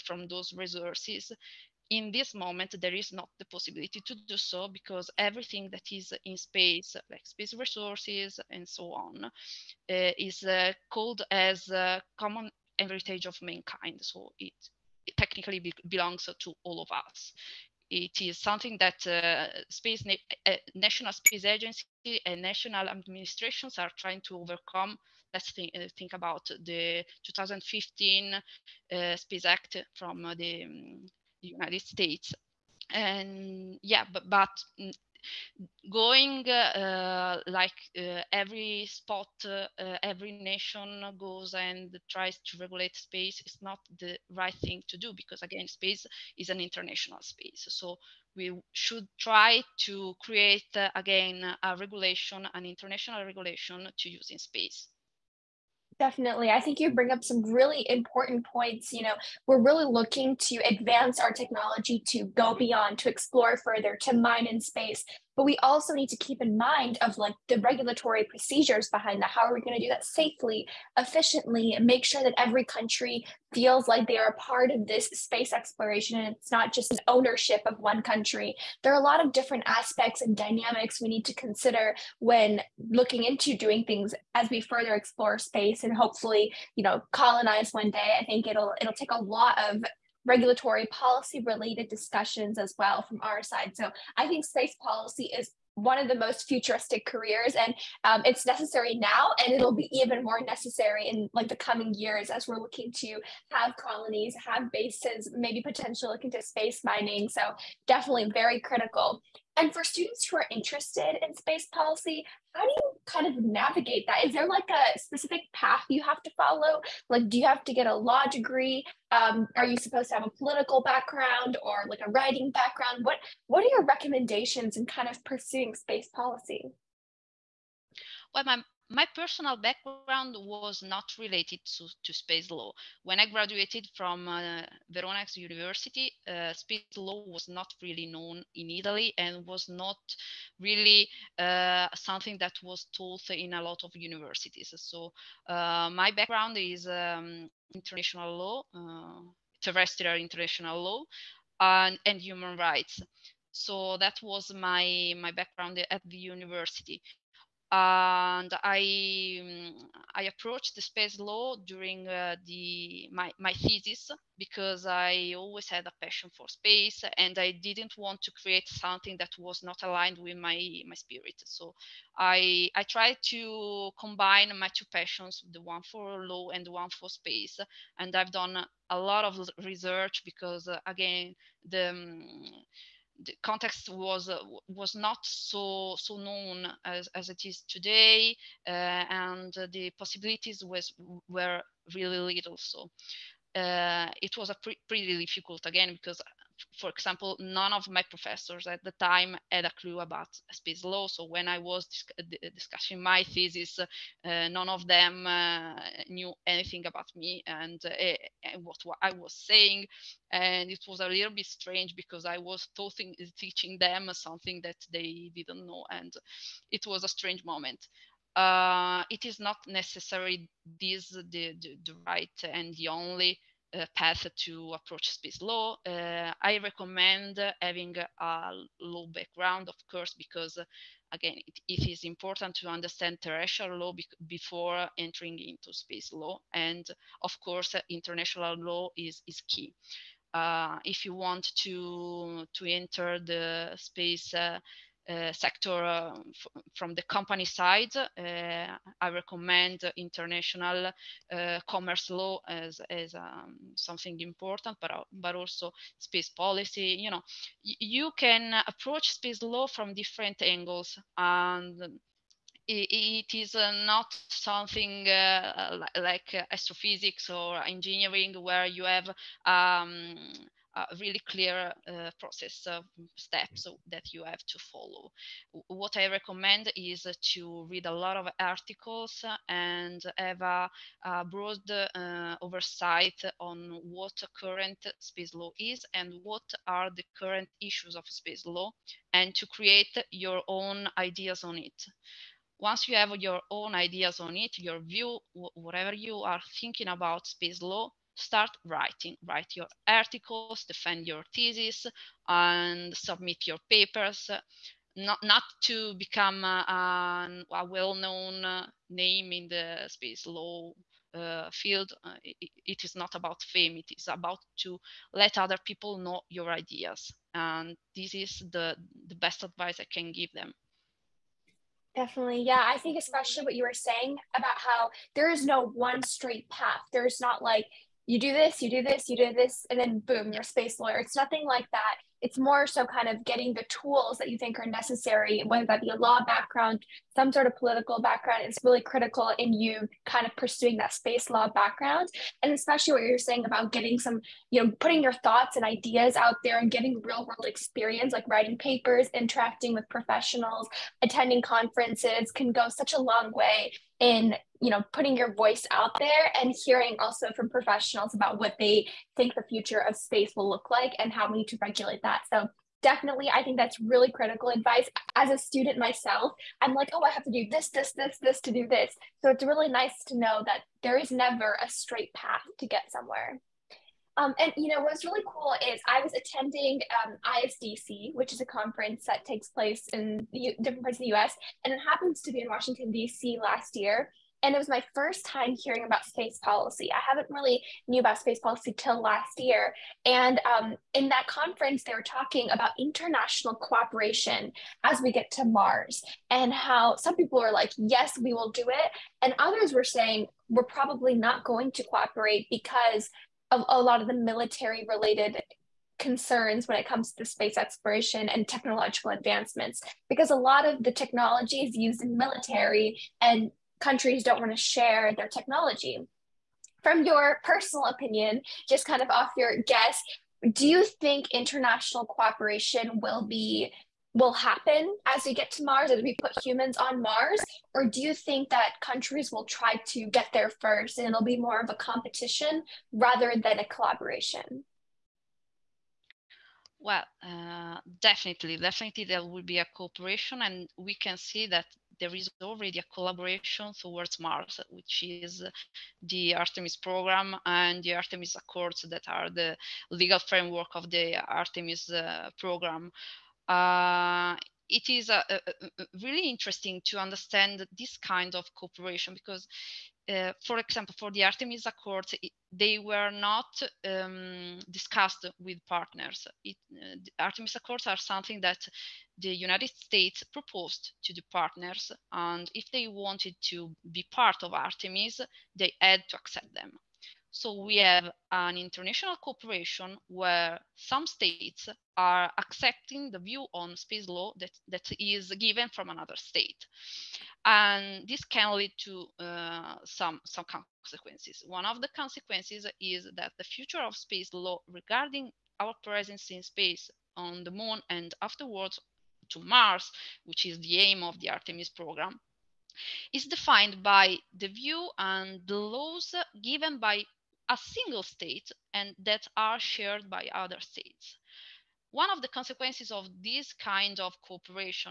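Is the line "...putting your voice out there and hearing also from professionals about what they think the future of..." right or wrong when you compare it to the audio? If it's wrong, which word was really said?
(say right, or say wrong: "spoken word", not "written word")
right.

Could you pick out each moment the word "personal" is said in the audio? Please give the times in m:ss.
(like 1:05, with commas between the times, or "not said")
2:09, 6:57.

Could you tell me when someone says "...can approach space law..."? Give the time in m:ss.
4:18.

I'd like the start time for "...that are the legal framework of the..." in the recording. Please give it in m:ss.
7:28.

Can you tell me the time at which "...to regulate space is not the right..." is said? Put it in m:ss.
0:42.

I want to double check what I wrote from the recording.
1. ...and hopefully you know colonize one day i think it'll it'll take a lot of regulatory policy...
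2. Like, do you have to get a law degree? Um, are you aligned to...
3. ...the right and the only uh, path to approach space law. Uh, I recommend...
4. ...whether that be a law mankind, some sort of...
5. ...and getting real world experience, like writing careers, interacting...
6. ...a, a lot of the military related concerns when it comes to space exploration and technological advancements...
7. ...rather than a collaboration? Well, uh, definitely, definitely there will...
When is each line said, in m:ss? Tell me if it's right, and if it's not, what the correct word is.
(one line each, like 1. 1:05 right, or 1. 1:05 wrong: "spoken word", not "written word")
1. 1:25 right
2. 1:57 wrong: "supposed", not "aligned"
3. 3:41 right
4. 5:35 wrong: "background", not "mankind"
5. 5:46 wrong: "papers", not "careers"
6. 6:43 right
7. 7:12 right.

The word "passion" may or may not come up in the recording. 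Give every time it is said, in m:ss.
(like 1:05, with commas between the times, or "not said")
2:46, 2:54.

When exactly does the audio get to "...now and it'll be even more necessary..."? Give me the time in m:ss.
1:38.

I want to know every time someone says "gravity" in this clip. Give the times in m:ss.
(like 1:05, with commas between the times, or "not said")
not said.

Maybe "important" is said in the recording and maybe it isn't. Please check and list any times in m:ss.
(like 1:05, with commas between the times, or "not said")
0:57, 3:52, 4:14.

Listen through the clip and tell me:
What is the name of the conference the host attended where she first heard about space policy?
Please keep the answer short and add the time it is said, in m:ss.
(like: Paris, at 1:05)
ISDC, at 6:17.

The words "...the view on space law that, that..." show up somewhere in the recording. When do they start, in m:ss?
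8:03.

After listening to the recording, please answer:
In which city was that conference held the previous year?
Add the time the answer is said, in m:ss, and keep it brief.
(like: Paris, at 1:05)
Washington D.C., at 6:22.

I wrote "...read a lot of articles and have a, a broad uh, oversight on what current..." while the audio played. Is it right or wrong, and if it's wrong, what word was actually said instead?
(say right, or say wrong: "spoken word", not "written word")
right.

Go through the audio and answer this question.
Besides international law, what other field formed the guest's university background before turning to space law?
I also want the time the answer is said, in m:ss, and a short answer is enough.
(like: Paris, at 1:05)
human rights, at 2:32.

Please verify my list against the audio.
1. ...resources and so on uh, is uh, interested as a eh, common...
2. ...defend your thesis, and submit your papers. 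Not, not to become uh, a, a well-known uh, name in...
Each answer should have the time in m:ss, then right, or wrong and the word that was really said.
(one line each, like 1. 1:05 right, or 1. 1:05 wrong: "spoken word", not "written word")
1. 0:07 wrong: "called", not "interested"
2. 5:00 right.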